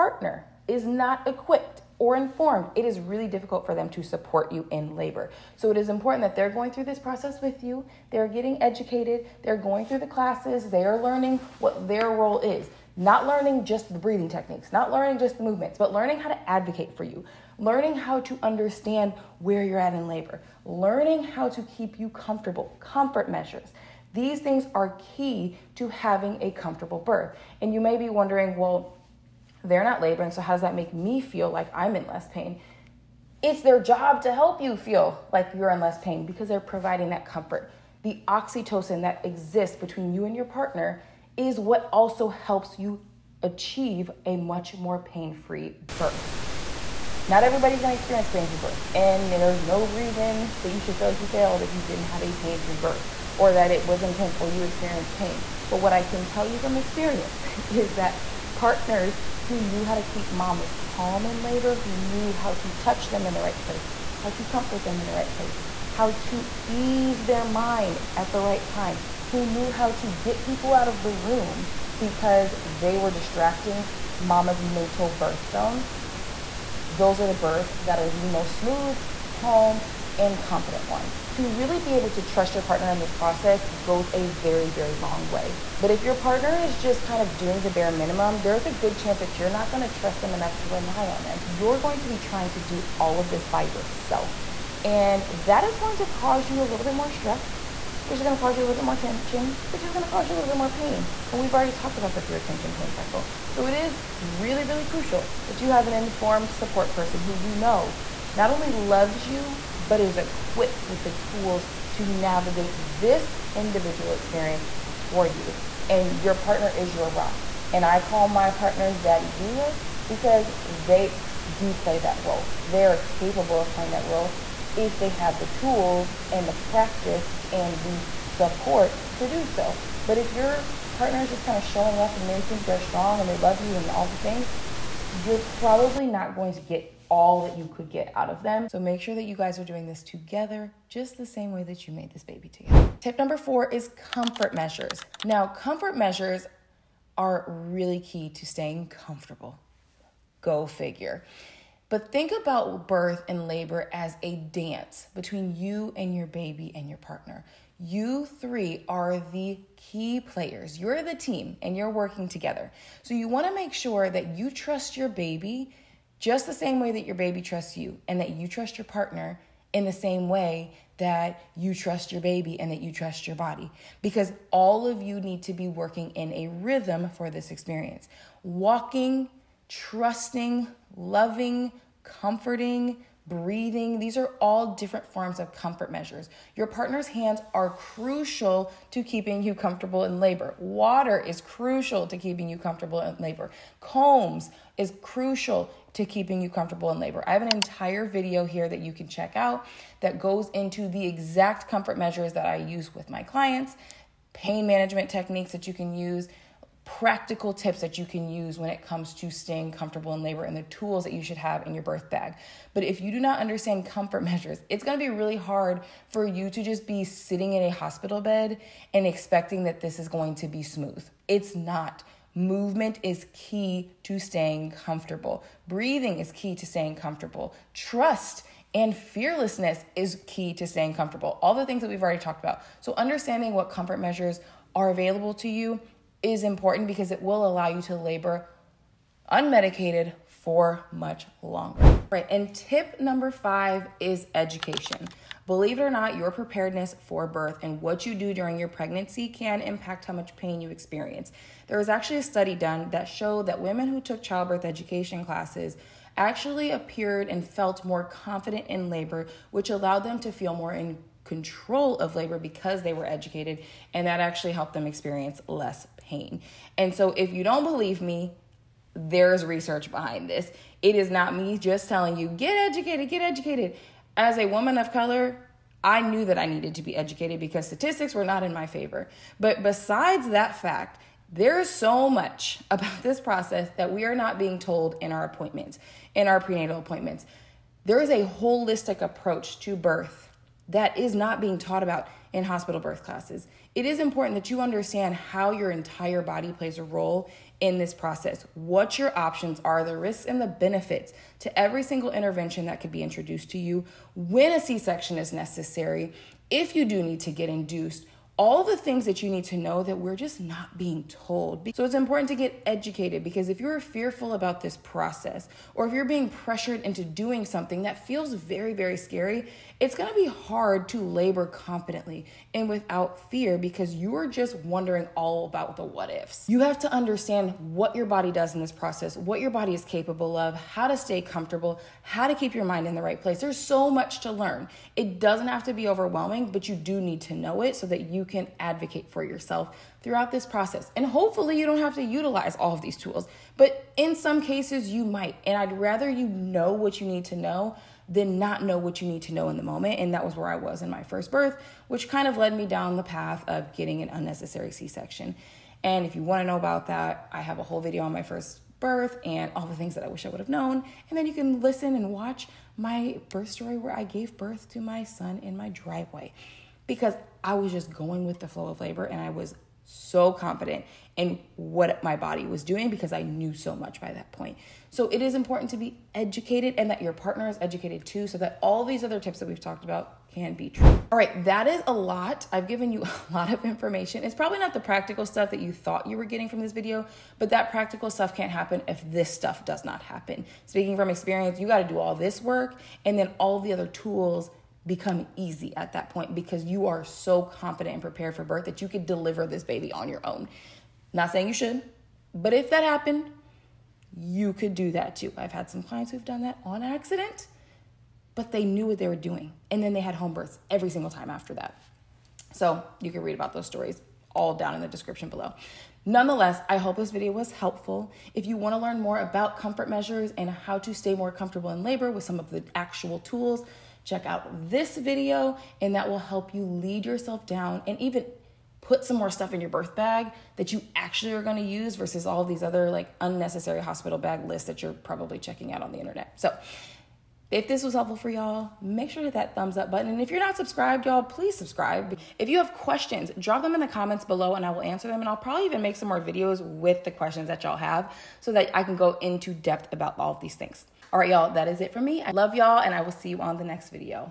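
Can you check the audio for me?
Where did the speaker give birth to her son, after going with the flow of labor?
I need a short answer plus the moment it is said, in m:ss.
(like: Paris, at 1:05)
in my driveway, at 6:05.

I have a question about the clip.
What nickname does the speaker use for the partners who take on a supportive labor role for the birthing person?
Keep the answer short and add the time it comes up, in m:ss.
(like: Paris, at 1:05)
daddy doulas, at 1:58.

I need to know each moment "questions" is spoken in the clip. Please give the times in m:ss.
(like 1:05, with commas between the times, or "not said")
7:22, 7:27.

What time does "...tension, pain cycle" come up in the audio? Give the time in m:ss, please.
1:42.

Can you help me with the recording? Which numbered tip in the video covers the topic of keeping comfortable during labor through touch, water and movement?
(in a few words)
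Tip number four.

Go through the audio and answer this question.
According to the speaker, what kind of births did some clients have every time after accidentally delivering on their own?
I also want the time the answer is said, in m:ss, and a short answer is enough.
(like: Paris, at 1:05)
home births, at 6:50.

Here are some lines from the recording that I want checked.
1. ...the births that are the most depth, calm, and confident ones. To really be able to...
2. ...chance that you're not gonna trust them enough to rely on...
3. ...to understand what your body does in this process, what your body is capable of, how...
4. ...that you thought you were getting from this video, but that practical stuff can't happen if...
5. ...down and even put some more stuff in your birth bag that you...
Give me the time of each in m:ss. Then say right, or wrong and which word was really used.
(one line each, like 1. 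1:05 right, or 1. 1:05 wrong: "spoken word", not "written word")
1. 1:17 wrong: "smooth", not "depth"
2. 1:28 right
3. 5:26 right
4. 6:25 right
5. 7:07 right.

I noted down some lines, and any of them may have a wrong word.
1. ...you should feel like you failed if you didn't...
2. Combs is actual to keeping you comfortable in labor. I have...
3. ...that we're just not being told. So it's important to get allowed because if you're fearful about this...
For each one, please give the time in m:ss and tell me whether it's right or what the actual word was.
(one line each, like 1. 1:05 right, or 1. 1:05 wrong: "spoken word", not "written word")
1. 0:50 right
2. 3:13 wrong: "crucial", not "actual"
3. 5:09 wrong: "educated", not "allowed".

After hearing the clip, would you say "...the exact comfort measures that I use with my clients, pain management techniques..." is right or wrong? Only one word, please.
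right.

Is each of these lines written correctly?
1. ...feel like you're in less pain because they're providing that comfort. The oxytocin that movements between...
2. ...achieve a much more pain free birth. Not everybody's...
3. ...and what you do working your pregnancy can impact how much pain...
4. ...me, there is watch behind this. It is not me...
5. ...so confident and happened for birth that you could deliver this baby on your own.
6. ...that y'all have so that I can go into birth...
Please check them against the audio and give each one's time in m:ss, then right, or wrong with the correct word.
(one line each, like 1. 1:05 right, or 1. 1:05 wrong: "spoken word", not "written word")
1. 0:34 wrong: "exists", not "movements"
2. 0:43 right
3. 4:07 wrong: "during", not "working"
4. 4:28 wrong: "research", not "watch"
5. 6:37 wrong: "prepared", not "happened"
6. 7:27 wrong: "depth", not "birth".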